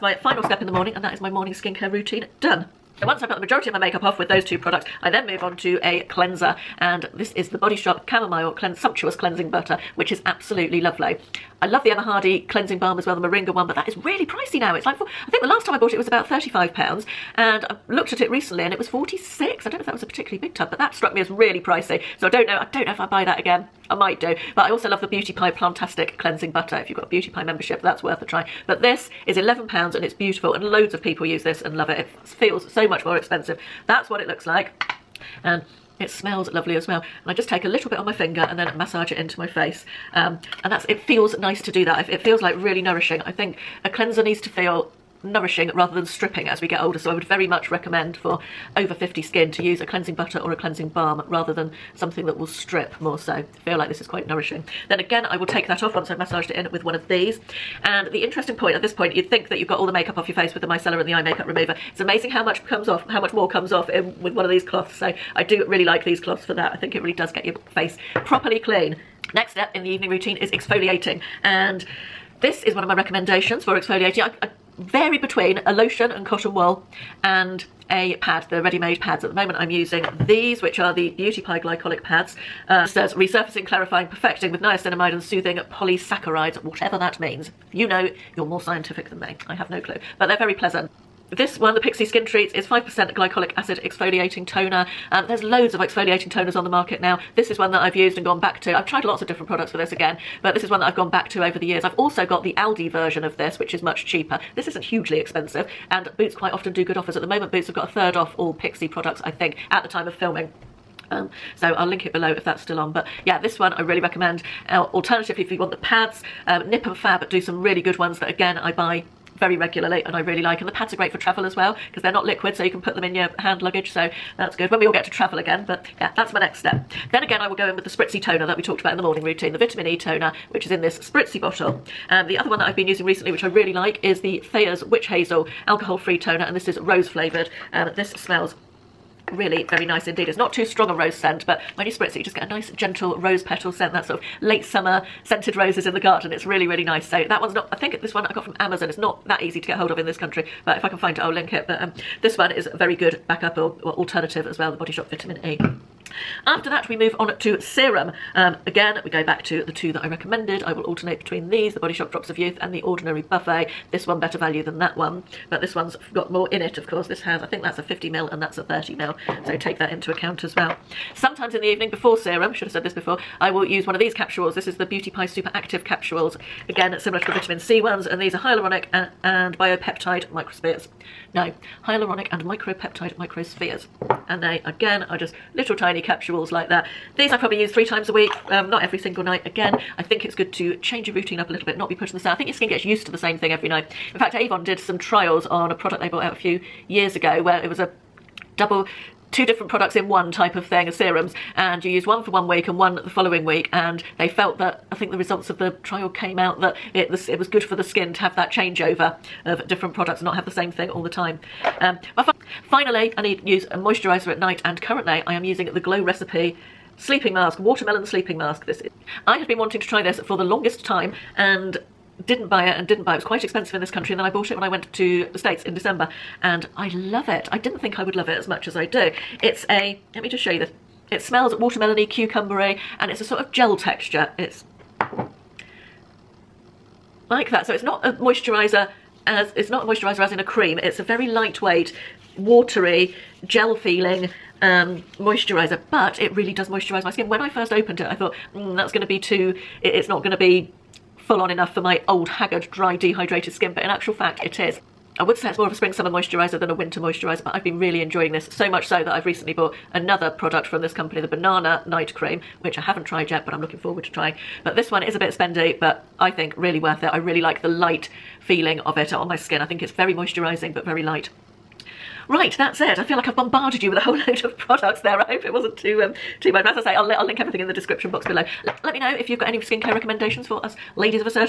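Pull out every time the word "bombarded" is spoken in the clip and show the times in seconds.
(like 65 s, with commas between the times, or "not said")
273 s.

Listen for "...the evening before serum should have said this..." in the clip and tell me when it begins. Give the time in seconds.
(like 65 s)
171 s.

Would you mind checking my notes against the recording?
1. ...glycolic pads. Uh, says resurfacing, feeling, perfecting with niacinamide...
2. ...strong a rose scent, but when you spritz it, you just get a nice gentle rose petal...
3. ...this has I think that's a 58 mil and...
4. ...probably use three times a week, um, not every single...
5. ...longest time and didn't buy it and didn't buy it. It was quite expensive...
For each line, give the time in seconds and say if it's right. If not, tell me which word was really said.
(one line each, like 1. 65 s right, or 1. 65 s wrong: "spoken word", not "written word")
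1. 81 s wrong: "clarifying", not "feeling"
2. 140 s right
3. 167 s wrong: "50", not "58"
4. 187 s right
5. 220 s right.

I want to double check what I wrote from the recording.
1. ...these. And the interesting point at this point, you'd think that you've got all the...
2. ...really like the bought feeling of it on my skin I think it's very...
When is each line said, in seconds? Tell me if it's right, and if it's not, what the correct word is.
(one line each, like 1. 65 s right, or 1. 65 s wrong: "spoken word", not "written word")
1. 57 s right
2. 267 s wrong: "light", not "bought".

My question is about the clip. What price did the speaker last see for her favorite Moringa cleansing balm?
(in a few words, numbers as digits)
£46.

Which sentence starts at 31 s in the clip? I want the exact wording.
It feels so much more expensive.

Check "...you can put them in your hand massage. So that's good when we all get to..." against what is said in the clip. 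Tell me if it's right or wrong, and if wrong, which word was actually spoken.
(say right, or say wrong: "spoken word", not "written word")
wrong: "luggage", not "massage".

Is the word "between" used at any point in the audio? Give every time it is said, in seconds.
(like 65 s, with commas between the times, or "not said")
75 s, 161 s.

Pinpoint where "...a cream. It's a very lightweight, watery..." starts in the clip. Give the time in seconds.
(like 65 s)
240 s.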